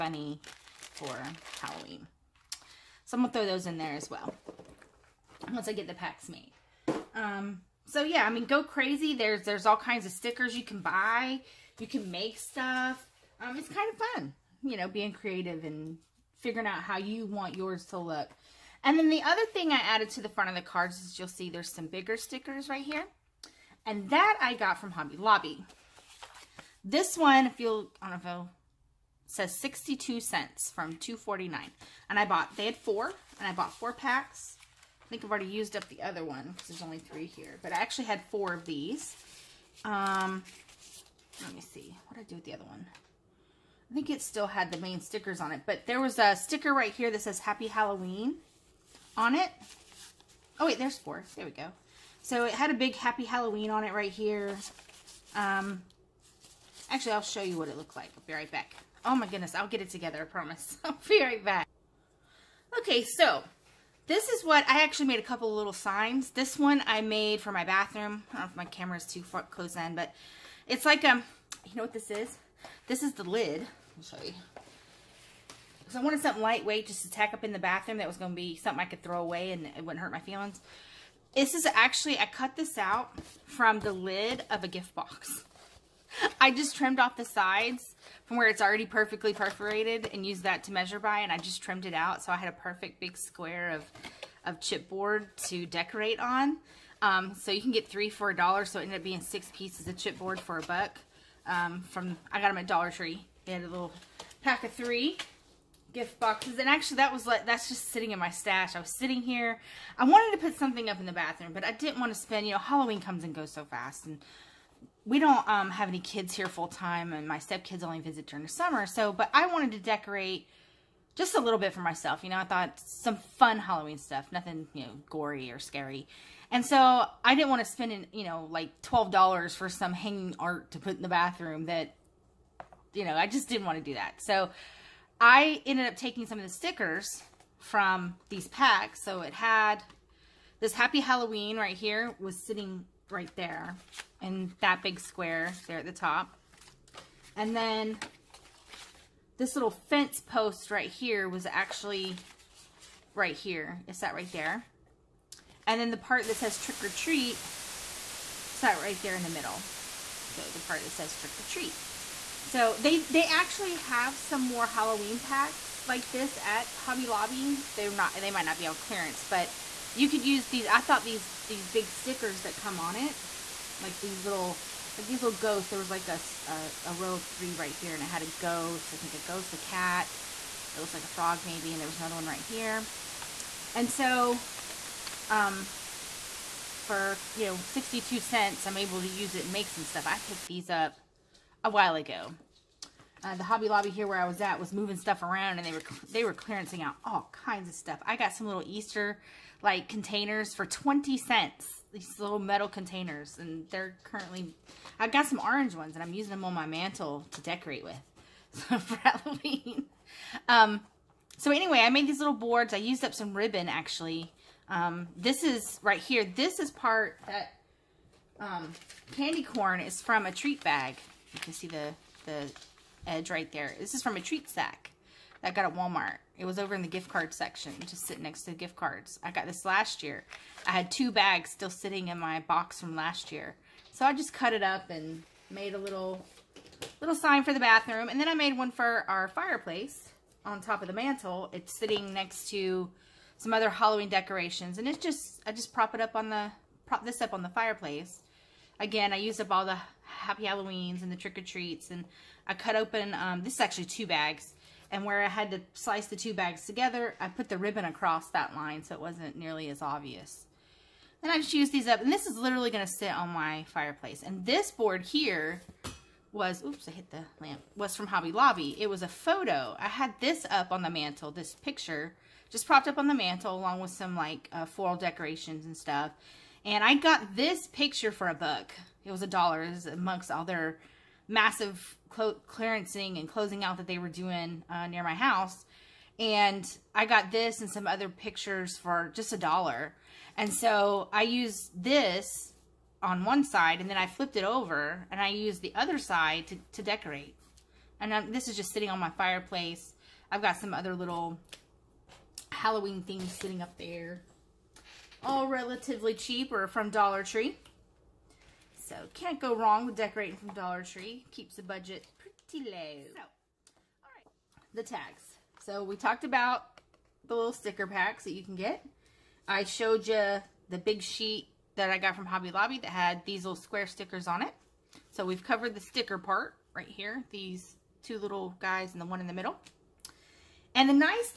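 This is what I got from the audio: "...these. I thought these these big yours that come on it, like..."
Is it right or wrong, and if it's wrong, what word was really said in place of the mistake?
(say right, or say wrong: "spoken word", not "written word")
wrong: "stickers", not "yours".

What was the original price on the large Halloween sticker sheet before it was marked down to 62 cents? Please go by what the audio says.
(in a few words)
$2.49.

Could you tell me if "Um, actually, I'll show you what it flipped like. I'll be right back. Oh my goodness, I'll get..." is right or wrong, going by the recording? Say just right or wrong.
wrong.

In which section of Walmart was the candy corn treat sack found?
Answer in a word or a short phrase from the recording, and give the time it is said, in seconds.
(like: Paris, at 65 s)
gift card section, at 226 s.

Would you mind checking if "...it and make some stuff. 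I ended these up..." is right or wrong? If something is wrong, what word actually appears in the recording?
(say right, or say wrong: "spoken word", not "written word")
wrong: "picked", not "ended".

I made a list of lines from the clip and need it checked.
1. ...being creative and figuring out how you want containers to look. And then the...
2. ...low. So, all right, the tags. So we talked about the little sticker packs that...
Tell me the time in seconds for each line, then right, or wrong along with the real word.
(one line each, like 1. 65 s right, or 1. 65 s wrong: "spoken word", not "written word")
1. 14 s wrong: "yours", not "containers"
2. 312 s right.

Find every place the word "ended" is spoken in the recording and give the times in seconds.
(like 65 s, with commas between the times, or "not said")
98 s, 135 s.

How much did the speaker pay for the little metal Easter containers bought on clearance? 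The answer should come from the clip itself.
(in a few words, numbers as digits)
20 cents.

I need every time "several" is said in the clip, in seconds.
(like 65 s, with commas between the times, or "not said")
not said.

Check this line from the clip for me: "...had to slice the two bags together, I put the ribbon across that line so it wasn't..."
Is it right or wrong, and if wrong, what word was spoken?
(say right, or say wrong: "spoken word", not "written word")
right.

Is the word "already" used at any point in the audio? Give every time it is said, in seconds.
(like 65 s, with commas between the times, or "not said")
35 s, 88 s.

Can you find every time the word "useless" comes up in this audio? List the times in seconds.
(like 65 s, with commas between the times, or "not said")
not said.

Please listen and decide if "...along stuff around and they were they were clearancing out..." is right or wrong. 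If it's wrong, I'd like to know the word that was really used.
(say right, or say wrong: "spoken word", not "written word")
wrong: "moving", not "along".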